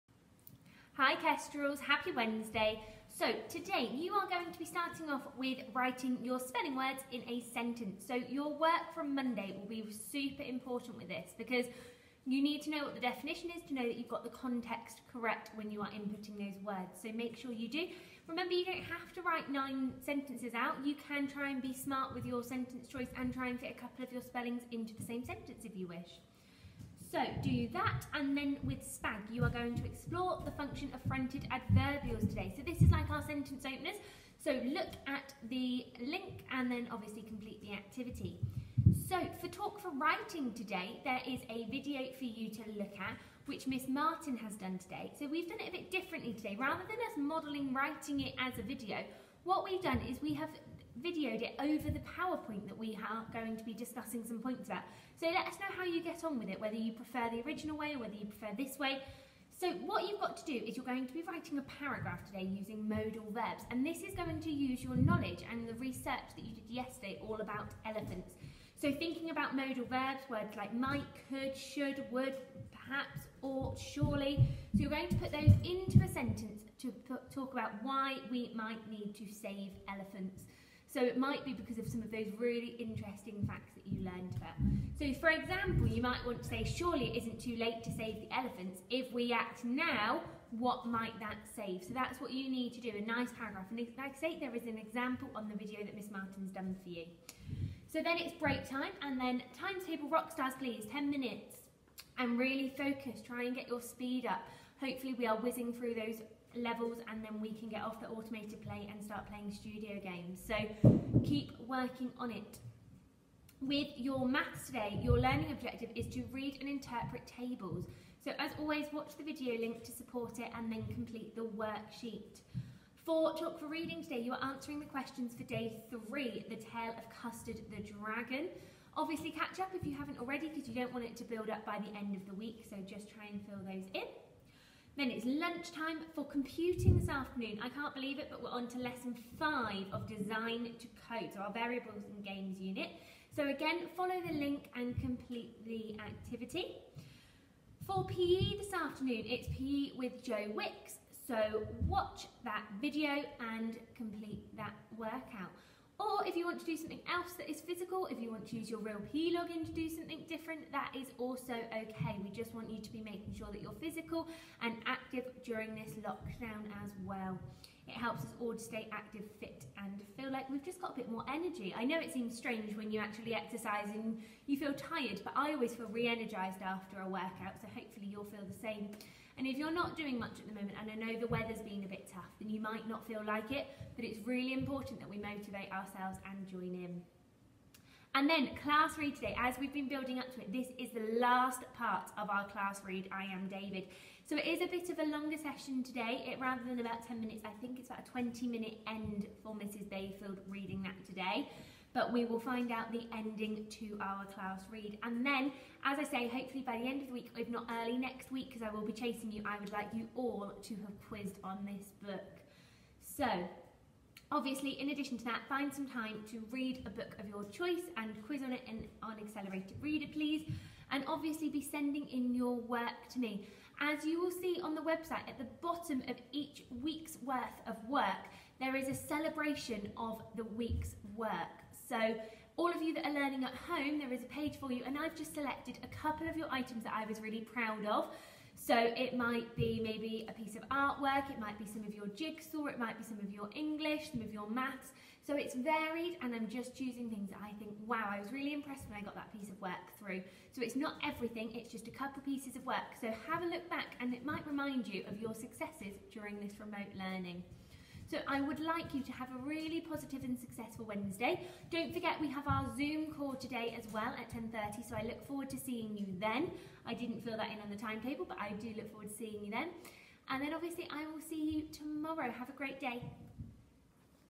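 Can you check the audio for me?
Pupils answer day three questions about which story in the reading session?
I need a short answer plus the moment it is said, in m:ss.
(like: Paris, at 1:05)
The Tale of Custard the Dragon, at 2:06.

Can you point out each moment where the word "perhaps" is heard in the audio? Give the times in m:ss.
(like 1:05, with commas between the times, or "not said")
1:12.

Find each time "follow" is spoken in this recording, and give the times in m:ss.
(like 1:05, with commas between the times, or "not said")
2:23.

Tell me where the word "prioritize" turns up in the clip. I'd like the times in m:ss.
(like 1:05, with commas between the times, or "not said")
not said.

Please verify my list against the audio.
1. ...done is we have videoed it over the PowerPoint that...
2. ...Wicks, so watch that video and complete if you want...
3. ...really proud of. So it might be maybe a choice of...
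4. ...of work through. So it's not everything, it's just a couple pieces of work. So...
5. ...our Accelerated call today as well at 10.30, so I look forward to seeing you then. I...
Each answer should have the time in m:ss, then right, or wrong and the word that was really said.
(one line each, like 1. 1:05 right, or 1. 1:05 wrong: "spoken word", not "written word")
1. 0:49 right
2. 2:30 right
3. 3:57 wrong: "piece", not "choice"
4. 4:09 right
5. 4:22 wrong: "Zoom", not "Accelerated".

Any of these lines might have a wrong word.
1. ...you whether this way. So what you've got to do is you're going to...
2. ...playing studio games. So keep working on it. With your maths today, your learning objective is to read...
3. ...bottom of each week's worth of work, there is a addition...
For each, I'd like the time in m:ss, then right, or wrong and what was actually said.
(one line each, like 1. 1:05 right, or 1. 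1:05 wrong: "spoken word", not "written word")
1. 0:58 wrong: "prefer", not "whether"
2. 1:49 right
3. 3:45 wrong: "celebration", not "addition".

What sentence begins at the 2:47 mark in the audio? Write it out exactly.
It helps us all to stay active, fit, and feel like we've just got a bit more energy.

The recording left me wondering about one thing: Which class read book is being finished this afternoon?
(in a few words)
I Am David.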